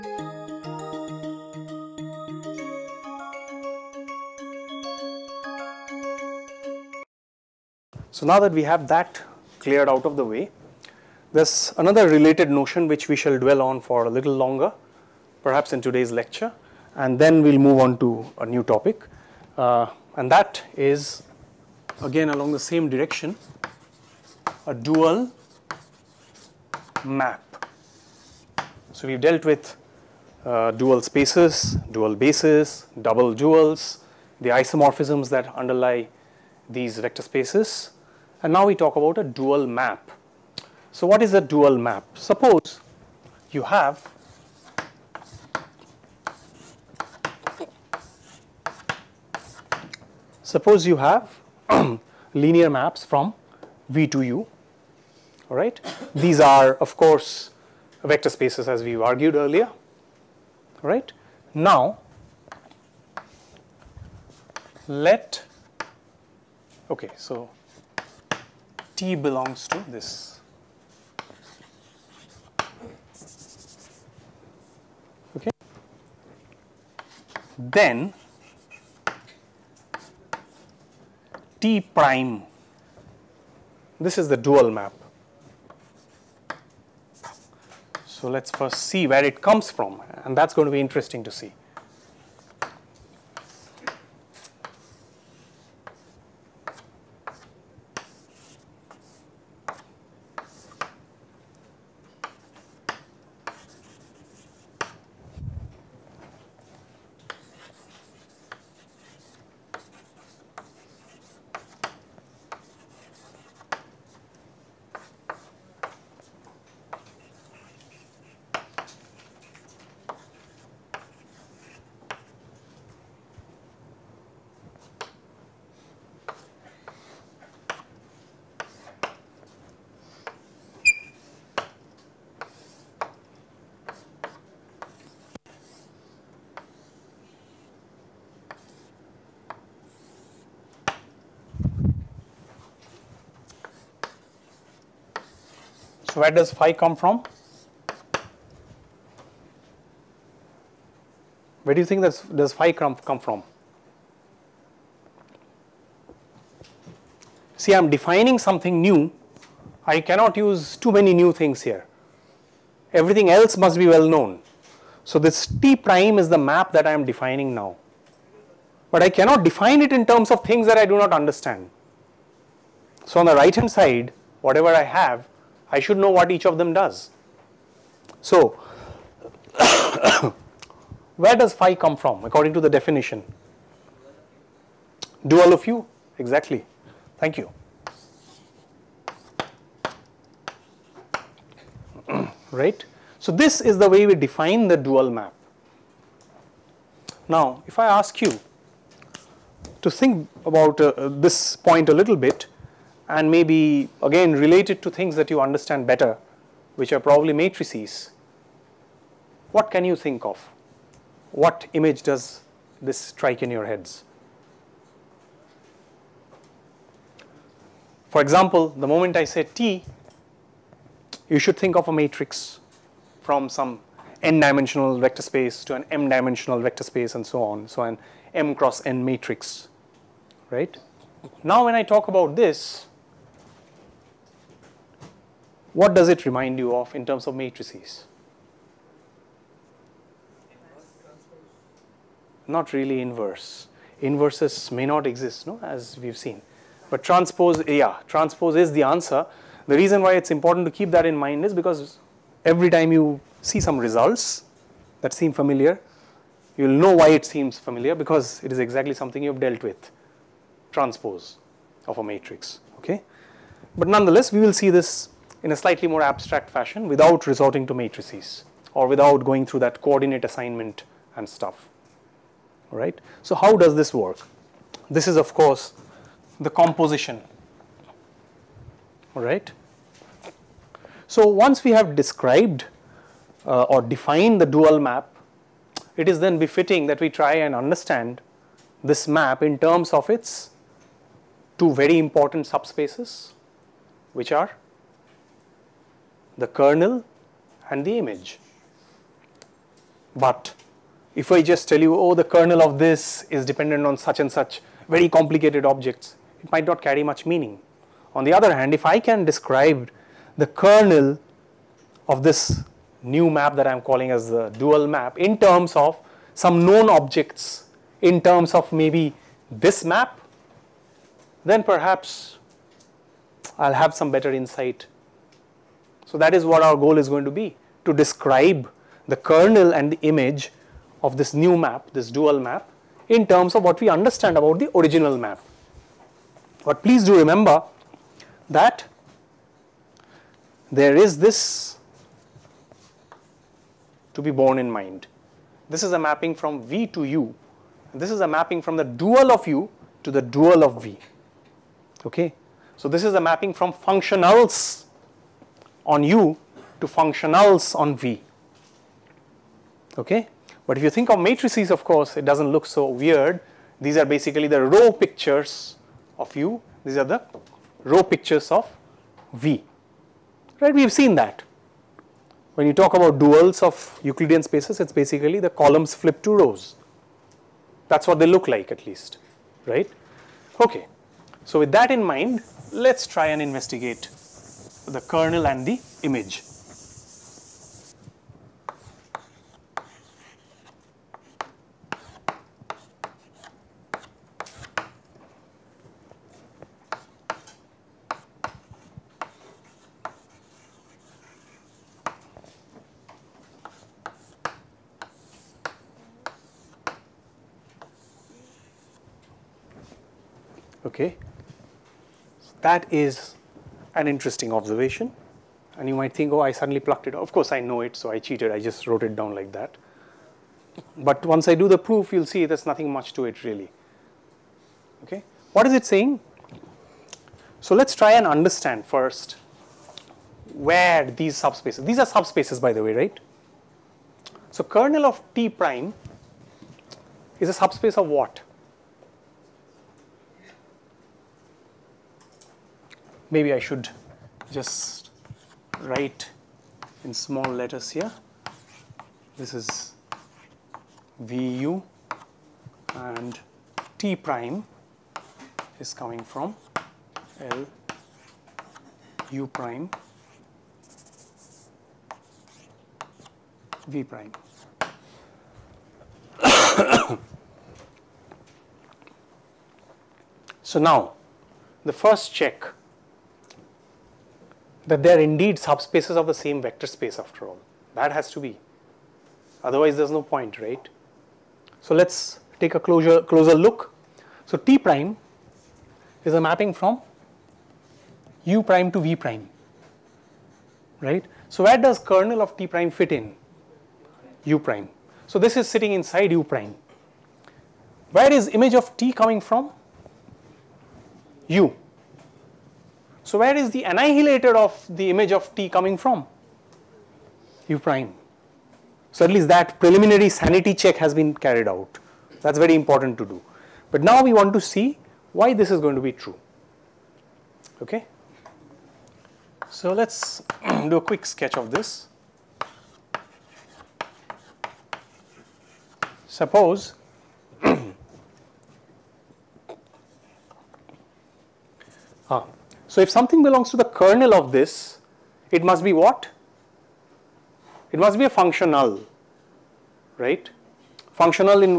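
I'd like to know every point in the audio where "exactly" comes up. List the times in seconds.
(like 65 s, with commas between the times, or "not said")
186 s, 258 s.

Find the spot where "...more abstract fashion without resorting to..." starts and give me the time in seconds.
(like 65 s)
265 s.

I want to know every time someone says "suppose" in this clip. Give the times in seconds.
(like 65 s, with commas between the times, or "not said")
42 s, 50 s, 526 s.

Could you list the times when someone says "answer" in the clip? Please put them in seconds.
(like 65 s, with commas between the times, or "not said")
248 s.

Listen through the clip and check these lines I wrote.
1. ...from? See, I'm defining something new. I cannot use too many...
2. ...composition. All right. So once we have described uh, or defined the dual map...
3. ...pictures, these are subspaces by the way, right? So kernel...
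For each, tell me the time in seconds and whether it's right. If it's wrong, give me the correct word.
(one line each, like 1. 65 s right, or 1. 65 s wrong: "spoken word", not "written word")
1. 153 s right
2. 276 s right
3. 431 s wrong: "subspaces", not "pictures".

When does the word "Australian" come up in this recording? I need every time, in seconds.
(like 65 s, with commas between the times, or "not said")
not said.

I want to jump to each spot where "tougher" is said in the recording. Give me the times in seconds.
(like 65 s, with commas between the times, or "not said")
not said.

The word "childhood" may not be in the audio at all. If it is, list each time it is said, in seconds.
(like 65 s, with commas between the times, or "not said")
not said.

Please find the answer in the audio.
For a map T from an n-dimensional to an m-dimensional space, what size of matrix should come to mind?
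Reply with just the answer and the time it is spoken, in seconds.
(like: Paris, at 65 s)
m cross n, at 228 s.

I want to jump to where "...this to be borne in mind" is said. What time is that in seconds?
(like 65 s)
341 s.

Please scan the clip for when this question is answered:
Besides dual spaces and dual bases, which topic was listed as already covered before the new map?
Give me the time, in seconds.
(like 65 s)
33 s.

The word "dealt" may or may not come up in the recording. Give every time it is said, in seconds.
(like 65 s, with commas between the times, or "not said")
29 s, 259 s.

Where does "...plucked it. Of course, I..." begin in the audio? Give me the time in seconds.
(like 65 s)
416 s.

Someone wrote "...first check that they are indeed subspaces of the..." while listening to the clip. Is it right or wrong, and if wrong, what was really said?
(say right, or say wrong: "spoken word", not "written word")
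right.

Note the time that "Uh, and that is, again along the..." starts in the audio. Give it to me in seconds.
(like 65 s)
19 s.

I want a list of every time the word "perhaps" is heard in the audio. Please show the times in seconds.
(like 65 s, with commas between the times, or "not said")
15 s, 321 s.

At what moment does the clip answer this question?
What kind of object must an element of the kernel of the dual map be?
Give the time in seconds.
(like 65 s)
537 s.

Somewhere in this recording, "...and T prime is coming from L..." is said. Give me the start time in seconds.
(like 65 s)
452 s.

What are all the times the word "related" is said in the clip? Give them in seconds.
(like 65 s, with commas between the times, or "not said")
12 s, 204 s.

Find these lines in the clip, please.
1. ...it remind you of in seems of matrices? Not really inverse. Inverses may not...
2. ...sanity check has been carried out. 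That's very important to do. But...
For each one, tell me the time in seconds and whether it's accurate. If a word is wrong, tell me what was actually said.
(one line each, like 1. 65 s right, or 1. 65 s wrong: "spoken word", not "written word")
1. 236 s wrong: "terms", not "seems"
2. 510 s right.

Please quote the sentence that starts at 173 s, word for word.
So on the right hand side, whatever I have I should know what each of them does.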